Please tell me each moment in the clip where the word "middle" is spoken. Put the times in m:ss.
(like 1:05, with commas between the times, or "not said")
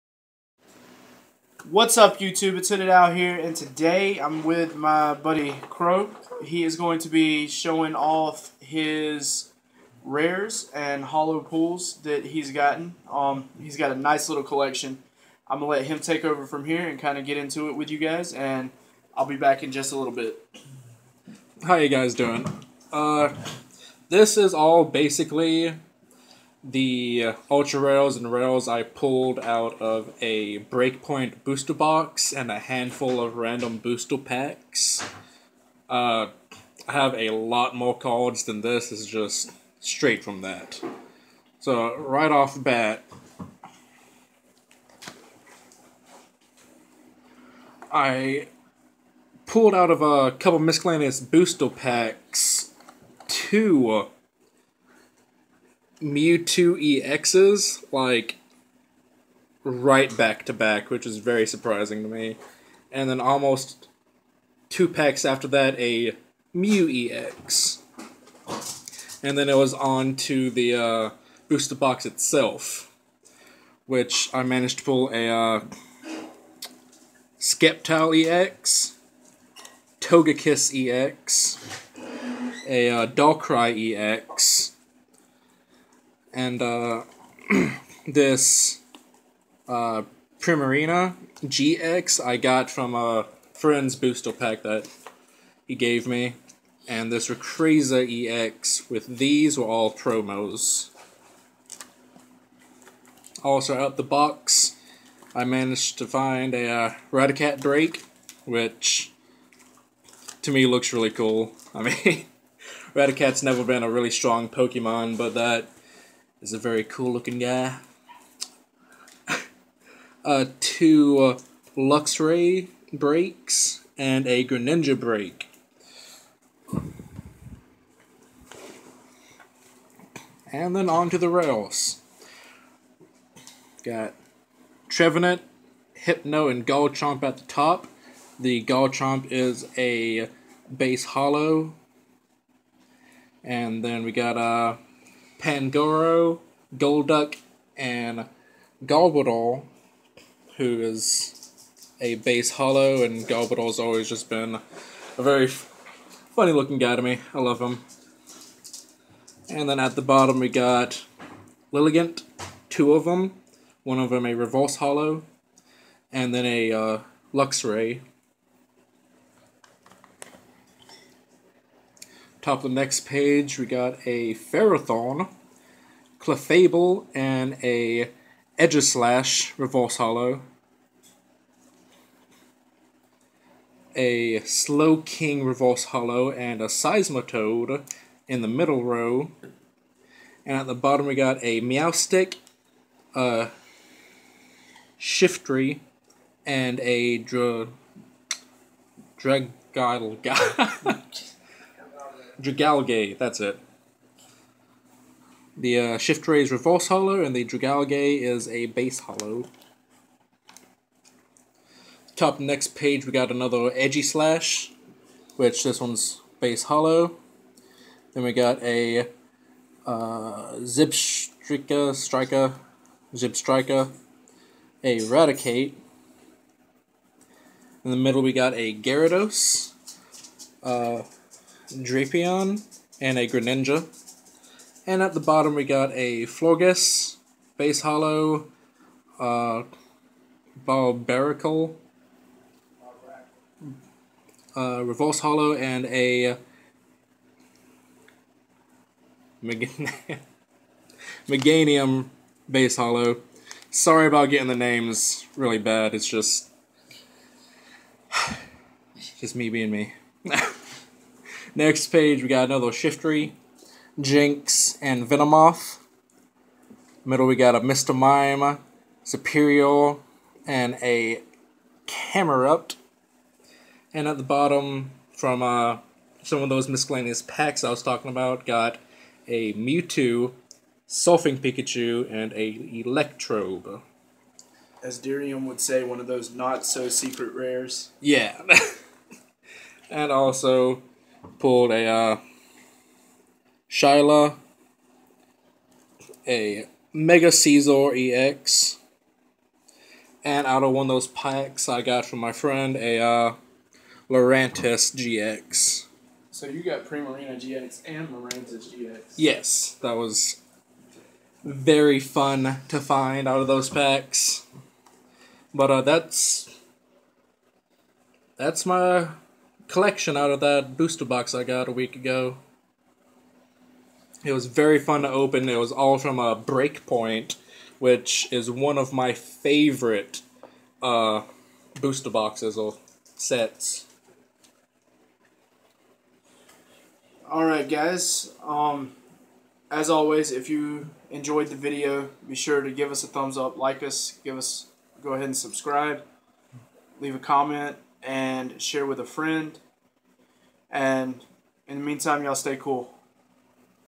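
3:08, 3:47, 4:27.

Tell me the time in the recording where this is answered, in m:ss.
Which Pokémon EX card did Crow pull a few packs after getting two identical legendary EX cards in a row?
1:06.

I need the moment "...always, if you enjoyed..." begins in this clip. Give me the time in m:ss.
5:39.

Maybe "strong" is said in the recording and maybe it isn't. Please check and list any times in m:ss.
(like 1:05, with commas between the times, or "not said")
1:54.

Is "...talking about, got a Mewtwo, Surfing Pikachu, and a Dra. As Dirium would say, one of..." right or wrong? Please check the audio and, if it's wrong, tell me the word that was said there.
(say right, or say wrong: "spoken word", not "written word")
wrong: "Electrode", not "Dra".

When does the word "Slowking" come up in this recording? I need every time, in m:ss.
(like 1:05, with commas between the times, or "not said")
3:04.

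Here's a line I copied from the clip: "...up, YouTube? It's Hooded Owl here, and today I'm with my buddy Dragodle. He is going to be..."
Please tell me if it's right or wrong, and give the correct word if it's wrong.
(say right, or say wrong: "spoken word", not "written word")
wrong: "Crow", not "Dragodle".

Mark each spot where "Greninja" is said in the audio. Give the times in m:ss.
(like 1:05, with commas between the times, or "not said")
2:04, 3:53.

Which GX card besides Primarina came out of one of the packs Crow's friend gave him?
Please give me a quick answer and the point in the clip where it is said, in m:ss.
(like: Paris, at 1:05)
Lurantis GX, at 5:08.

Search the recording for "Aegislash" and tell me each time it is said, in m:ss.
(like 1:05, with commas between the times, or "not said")
2:58, 3:33.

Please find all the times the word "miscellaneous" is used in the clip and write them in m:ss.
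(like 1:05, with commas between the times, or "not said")
0:50, 4:36.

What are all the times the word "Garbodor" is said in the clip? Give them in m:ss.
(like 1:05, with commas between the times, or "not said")
2:28, 2:33.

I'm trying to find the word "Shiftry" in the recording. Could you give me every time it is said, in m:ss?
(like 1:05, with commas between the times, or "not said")
3:14, 3:25, 4:22.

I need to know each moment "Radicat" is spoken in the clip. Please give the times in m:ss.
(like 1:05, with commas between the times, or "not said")
1:47, 1:52.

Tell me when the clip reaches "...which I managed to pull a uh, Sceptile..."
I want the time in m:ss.
1:13.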